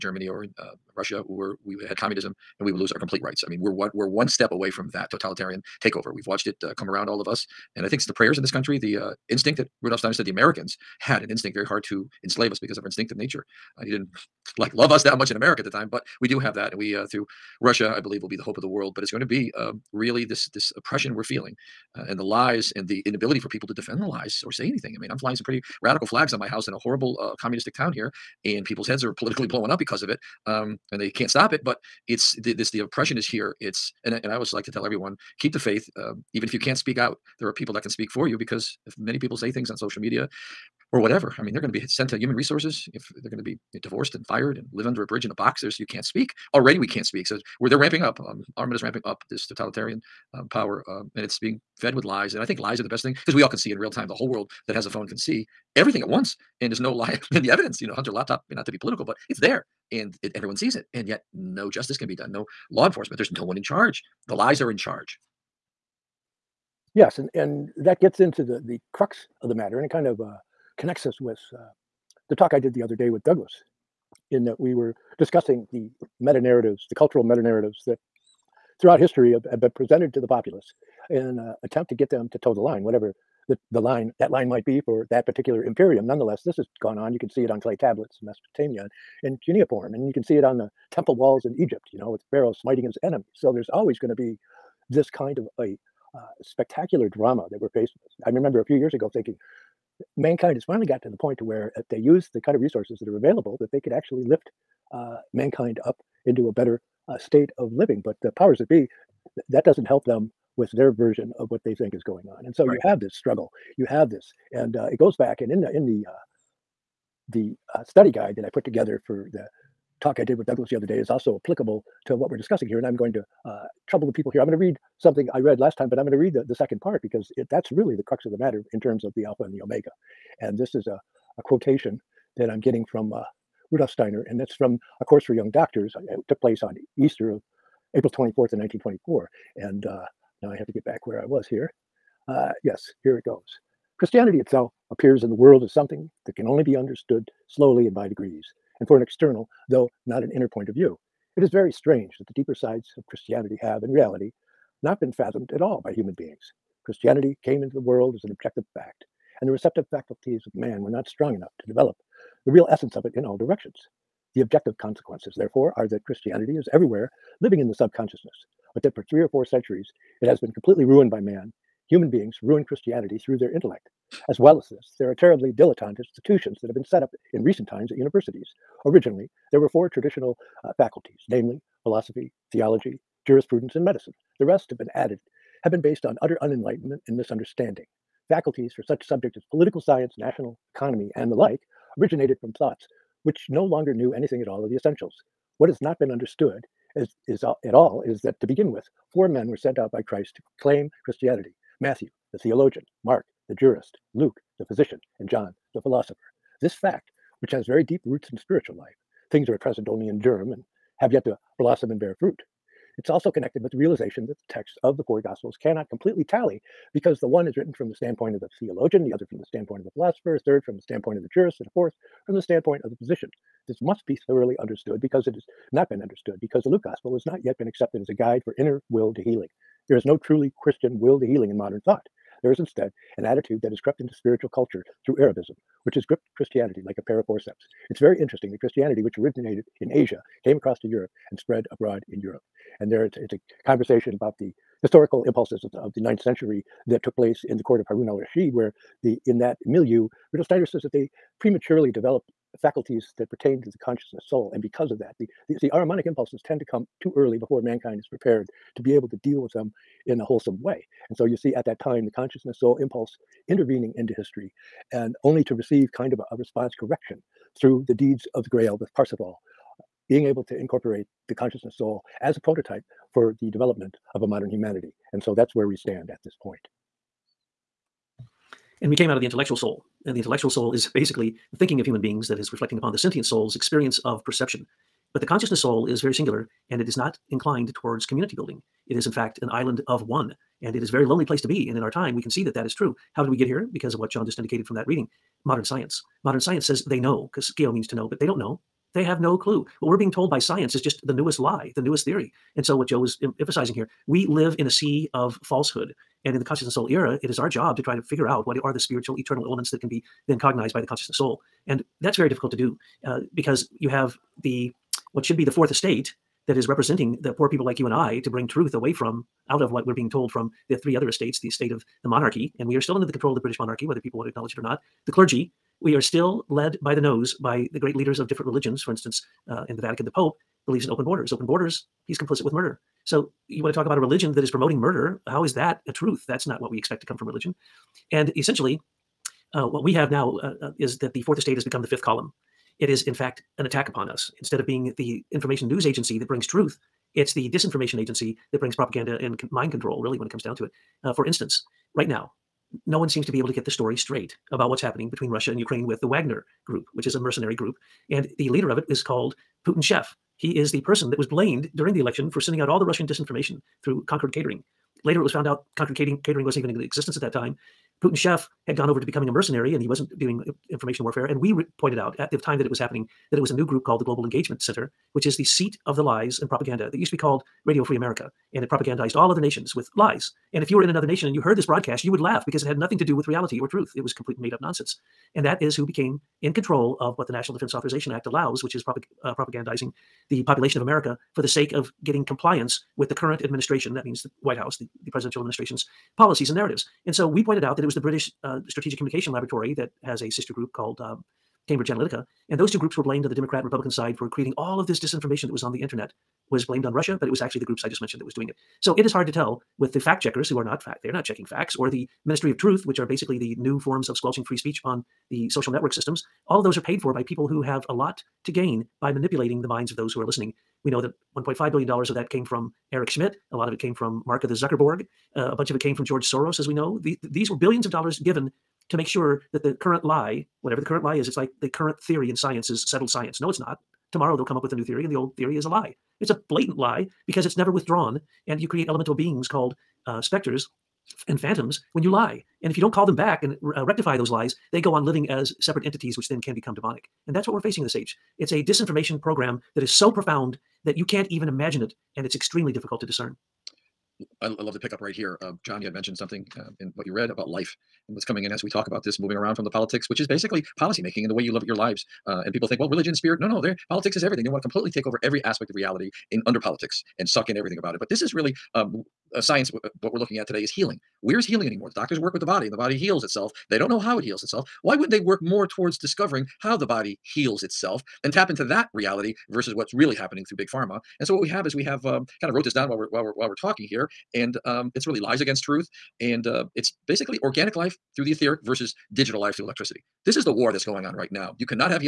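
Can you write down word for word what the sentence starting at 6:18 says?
And it propagandized all other nations with lies.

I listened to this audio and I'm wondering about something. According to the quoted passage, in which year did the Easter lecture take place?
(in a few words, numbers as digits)
1924.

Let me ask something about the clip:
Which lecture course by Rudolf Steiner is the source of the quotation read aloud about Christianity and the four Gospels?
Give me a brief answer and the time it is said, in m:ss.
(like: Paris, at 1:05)
A Course for Young Doctors, at 2:15.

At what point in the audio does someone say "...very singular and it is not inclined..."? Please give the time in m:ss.
4:46.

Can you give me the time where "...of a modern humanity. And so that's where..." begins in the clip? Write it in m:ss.
4:34.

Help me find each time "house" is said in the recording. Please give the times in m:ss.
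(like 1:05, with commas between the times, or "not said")
0:26, 6:34.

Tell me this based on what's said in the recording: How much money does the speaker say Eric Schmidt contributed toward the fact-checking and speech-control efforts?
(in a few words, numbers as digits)
$1.5 billion.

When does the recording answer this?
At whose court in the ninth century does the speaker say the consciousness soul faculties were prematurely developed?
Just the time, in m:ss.
4:07.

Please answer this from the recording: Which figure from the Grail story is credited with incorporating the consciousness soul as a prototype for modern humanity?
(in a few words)
Parsifal.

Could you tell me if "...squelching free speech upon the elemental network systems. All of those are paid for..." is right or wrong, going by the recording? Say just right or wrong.
wrong.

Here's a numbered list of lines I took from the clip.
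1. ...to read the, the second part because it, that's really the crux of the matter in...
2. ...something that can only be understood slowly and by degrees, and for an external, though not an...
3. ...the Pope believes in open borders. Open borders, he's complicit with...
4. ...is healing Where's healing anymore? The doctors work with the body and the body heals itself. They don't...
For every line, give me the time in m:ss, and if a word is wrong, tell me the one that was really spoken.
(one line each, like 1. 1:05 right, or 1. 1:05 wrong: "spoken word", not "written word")
1. 2:06 right
2. 2:25 right
3. 5:30 right
4. 7:50 right.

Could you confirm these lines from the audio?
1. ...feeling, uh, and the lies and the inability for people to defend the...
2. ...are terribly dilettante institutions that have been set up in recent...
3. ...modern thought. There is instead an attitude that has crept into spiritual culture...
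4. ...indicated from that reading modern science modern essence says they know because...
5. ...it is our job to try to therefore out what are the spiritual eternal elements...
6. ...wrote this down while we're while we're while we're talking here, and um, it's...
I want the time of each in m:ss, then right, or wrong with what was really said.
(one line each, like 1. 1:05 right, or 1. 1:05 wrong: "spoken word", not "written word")
1. 0:21 right
2. 2:55 right
3. 3:51 right
4. 4:54 wrong: "science", not "essence"
5. 5:07 wrong: "figure", not "therefore"
6. 8:02 right.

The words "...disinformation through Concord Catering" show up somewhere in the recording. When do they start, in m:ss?
6:03.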